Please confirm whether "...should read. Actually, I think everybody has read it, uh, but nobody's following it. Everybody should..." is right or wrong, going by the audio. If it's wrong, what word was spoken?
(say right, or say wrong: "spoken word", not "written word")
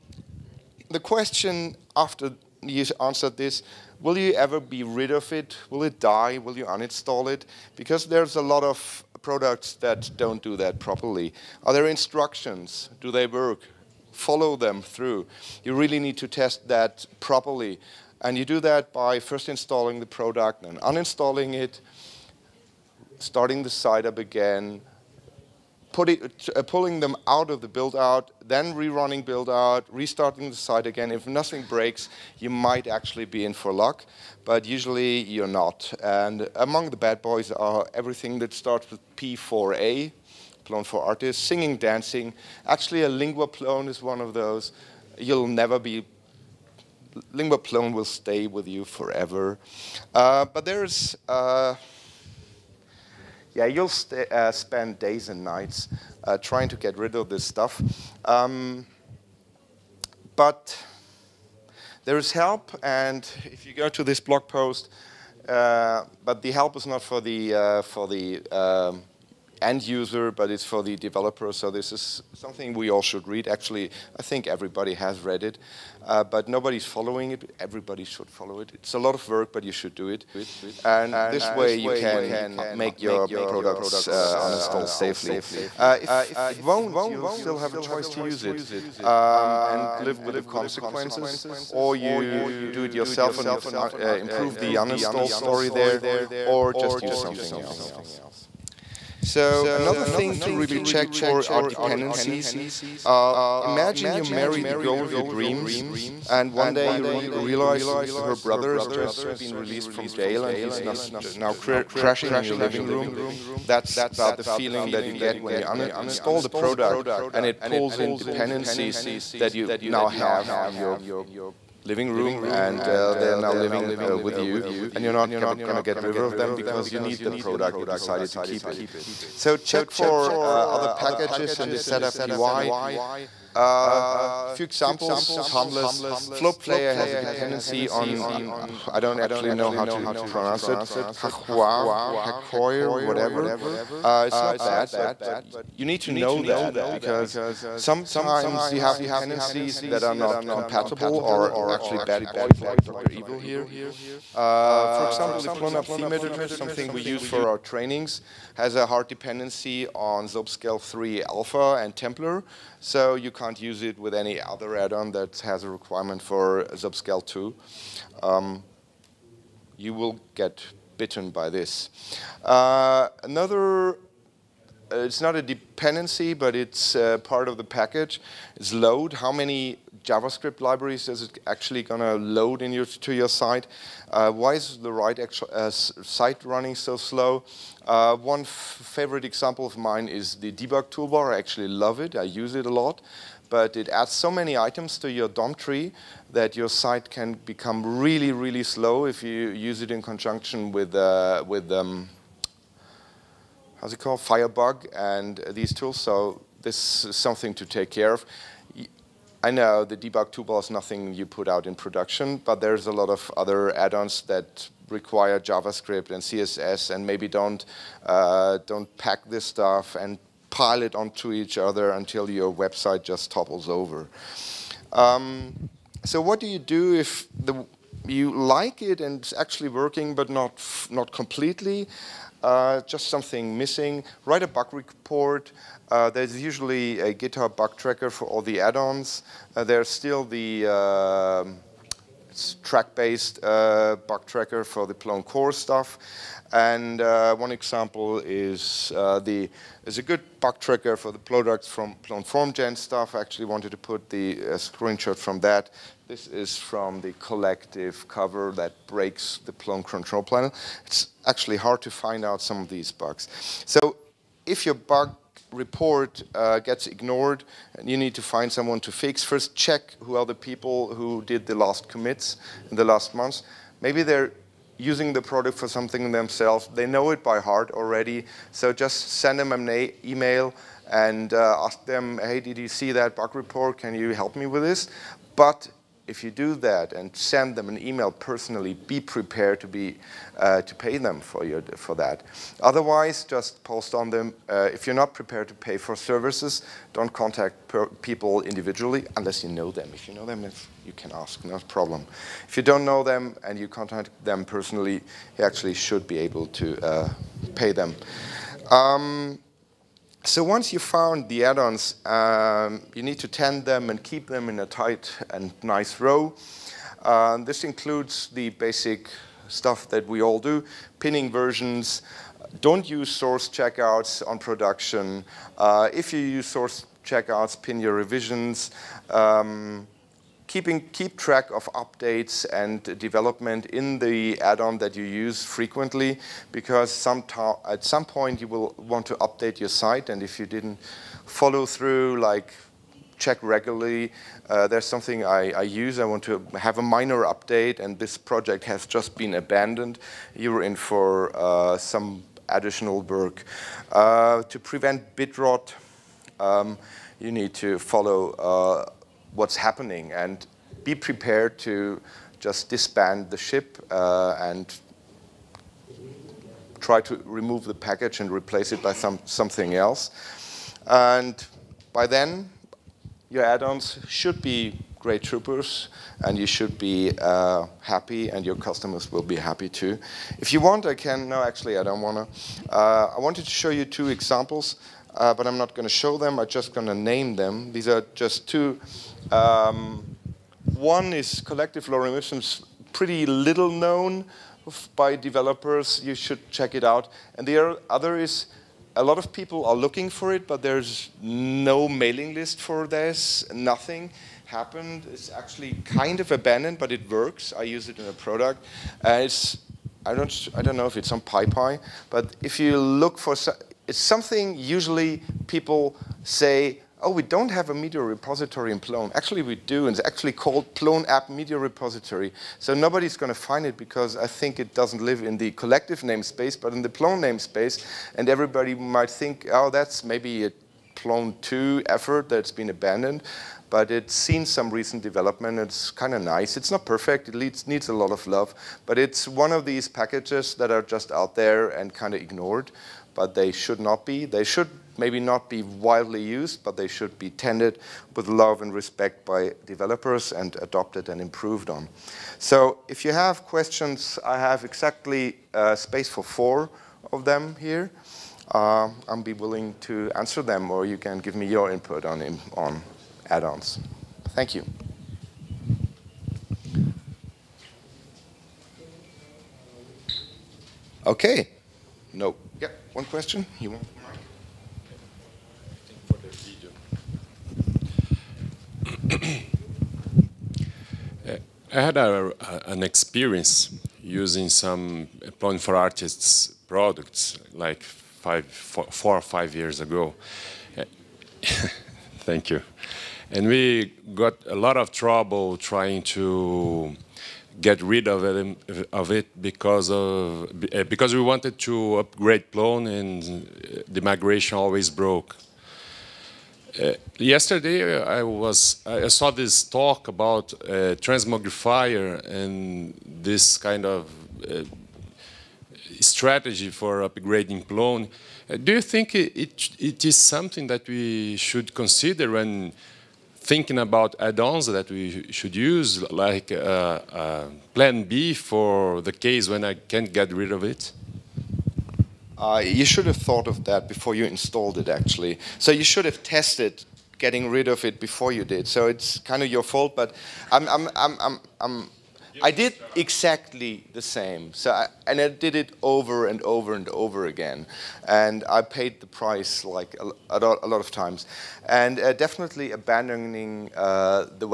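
right.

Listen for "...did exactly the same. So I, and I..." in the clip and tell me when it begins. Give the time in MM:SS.
09:02.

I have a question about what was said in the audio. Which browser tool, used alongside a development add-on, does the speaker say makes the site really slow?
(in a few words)
Firebug.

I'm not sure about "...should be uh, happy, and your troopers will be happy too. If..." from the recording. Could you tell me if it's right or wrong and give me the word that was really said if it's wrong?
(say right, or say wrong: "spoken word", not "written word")
wrong: "customers", not "troopers".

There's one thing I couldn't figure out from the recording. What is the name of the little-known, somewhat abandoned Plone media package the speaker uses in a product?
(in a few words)
Plone App Media Repository.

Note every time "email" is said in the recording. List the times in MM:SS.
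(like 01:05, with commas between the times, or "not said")
04:40, 04:47.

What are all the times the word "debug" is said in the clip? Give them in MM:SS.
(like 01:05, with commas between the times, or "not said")
03:10, 03:29.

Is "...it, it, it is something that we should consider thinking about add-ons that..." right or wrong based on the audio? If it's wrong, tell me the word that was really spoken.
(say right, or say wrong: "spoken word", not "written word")
right.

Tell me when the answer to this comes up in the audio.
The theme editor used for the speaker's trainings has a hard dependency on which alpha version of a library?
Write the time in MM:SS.
02:40.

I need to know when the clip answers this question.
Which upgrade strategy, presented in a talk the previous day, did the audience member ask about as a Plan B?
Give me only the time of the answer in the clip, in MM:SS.
08:31.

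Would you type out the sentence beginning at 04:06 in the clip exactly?
And uh, one example is uh, the is a good bug tracker for the products from Plone FormGen stuff.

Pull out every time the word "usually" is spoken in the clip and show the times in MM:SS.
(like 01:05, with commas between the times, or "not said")
00:34, 03:56, 06:54.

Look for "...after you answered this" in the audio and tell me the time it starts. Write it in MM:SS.
00:01.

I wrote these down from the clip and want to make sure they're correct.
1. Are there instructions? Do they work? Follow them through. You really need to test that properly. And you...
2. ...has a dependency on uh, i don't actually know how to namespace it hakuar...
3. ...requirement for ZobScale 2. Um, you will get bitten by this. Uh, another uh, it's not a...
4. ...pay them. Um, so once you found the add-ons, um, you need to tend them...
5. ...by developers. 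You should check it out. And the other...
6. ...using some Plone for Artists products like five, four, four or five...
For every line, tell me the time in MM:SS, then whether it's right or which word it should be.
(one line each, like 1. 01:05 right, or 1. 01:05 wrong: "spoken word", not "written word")
1. 00:11 right
2. 02:16 wrong: "pronounce", not "namespace"
3. 02:45 right
4. 05:07 right
5. 06:34 right
6. 08:04 right.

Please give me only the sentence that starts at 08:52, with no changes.
Uh, you should have thought of that before you installed it, actually.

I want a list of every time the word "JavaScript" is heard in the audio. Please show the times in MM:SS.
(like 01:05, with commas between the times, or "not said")
03:00, 03:35.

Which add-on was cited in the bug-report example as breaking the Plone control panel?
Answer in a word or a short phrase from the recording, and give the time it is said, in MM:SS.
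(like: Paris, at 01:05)
collective cover, at 04:17.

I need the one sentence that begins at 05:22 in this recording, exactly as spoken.
Don't use source checkouts on production.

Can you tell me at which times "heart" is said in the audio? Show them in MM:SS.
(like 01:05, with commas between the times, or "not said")
04:37.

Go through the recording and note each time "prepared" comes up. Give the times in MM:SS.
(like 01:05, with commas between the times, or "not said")
04:48, 04:55, 06:00.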